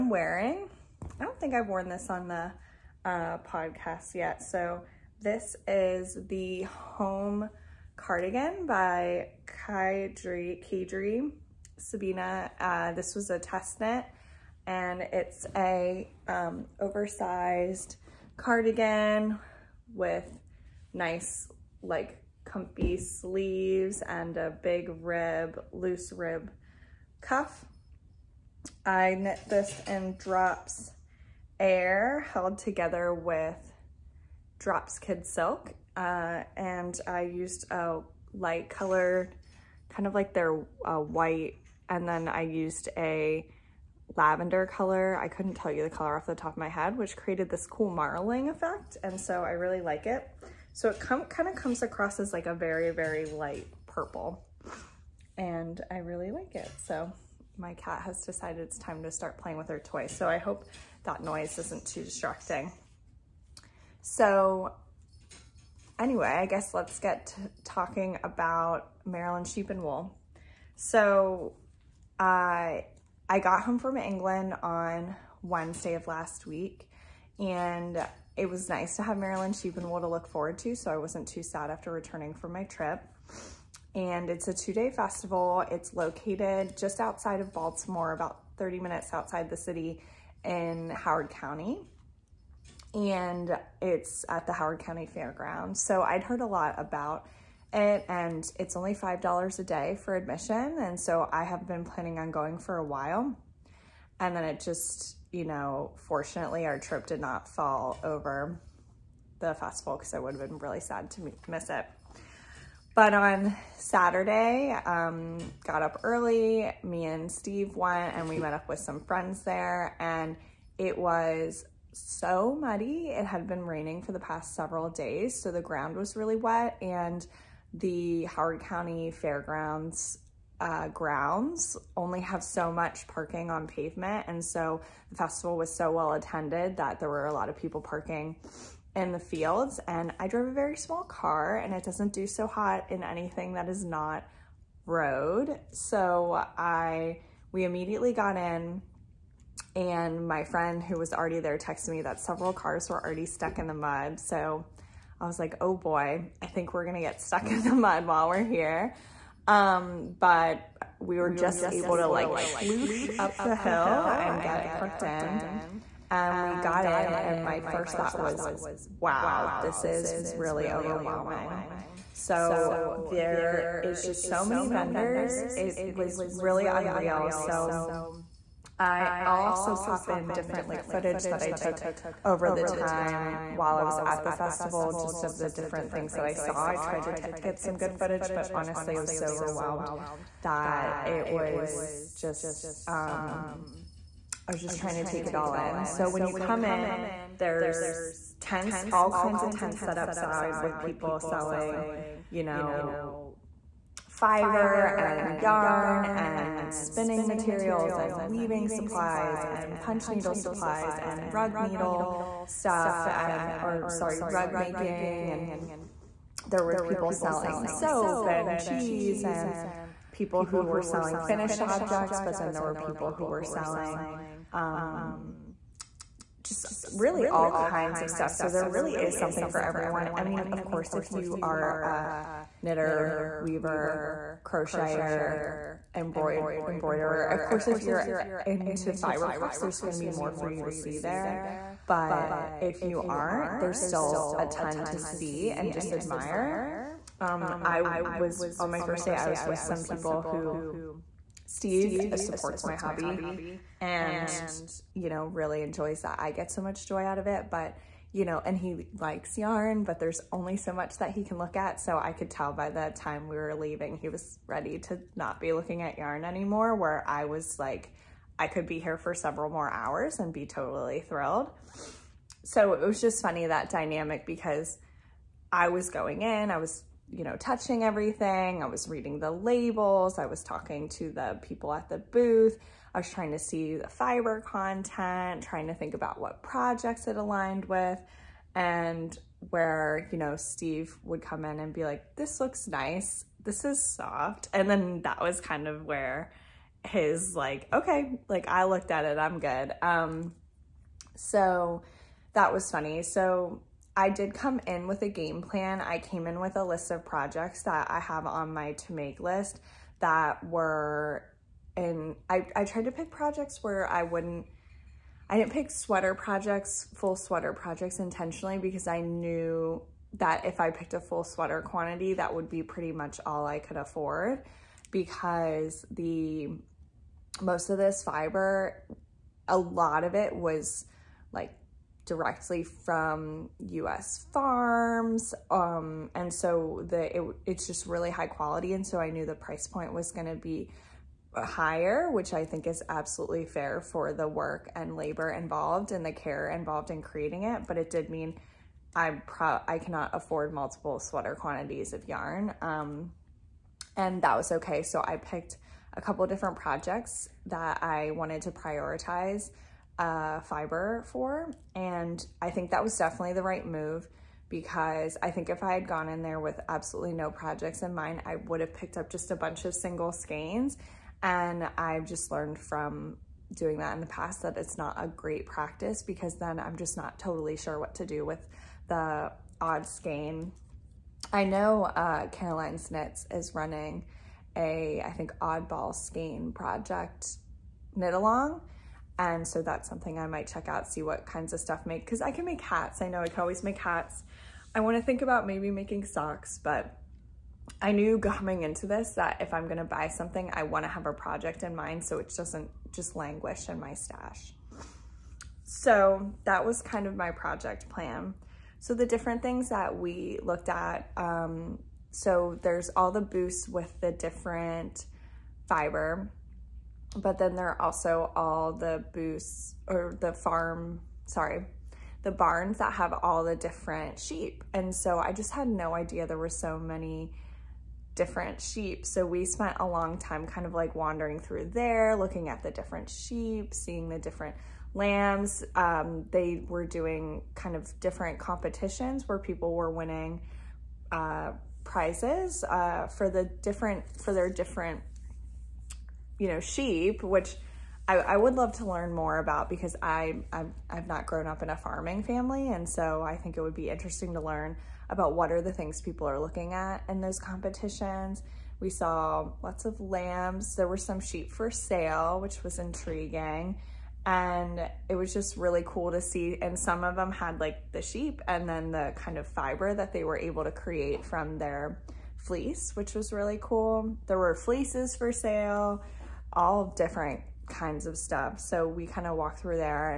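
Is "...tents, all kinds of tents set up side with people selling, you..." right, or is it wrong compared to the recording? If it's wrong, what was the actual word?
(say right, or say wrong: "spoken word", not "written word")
right.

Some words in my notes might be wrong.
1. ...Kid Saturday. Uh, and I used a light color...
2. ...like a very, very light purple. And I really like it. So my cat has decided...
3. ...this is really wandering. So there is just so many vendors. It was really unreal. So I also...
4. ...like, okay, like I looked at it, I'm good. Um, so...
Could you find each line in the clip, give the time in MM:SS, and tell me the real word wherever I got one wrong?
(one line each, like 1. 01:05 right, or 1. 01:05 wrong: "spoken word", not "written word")
1. 00:34 wrong: "Silk", not "Saturday"
2. 00:52 right
3. 02:49 wrong: "overwhelming", not "wandering"
4. 04:57 right.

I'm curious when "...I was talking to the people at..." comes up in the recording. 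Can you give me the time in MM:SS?
04:40.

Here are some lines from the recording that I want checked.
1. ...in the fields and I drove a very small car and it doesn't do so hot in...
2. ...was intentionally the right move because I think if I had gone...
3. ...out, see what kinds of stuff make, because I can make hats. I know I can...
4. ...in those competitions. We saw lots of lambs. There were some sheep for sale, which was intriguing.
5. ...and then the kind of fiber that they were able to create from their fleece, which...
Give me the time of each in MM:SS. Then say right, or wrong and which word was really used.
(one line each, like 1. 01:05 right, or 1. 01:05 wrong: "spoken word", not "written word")
1. 02:18 right
2. 06:02 wrong: "definitely", not "intentionally"
3. 06:30 right
4. 07:37 right
5. 07:48 right.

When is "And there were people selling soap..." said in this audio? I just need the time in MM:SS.
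03:35.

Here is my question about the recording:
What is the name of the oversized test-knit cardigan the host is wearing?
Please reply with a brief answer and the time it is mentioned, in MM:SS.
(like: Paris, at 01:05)
Home Cardigan, at 00:06.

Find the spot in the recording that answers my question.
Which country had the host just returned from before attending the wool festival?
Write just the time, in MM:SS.
01:13.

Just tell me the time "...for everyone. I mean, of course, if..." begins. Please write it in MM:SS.
03:49.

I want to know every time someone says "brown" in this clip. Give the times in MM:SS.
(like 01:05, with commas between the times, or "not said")
not said.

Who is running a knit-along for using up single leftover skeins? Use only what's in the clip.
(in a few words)
Caroline Snitz.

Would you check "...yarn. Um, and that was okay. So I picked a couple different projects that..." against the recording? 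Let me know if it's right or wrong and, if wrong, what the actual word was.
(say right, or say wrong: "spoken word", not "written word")
right.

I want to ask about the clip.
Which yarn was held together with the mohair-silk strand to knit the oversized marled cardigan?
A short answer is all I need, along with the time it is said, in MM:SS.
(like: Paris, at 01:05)
Drops Air, at 00:30.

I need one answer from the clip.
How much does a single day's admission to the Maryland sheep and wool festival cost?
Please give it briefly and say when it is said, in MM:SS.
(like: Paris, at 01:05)
$5, at 01:38.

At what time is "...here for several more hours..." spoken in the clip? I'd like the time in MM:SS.
04:28.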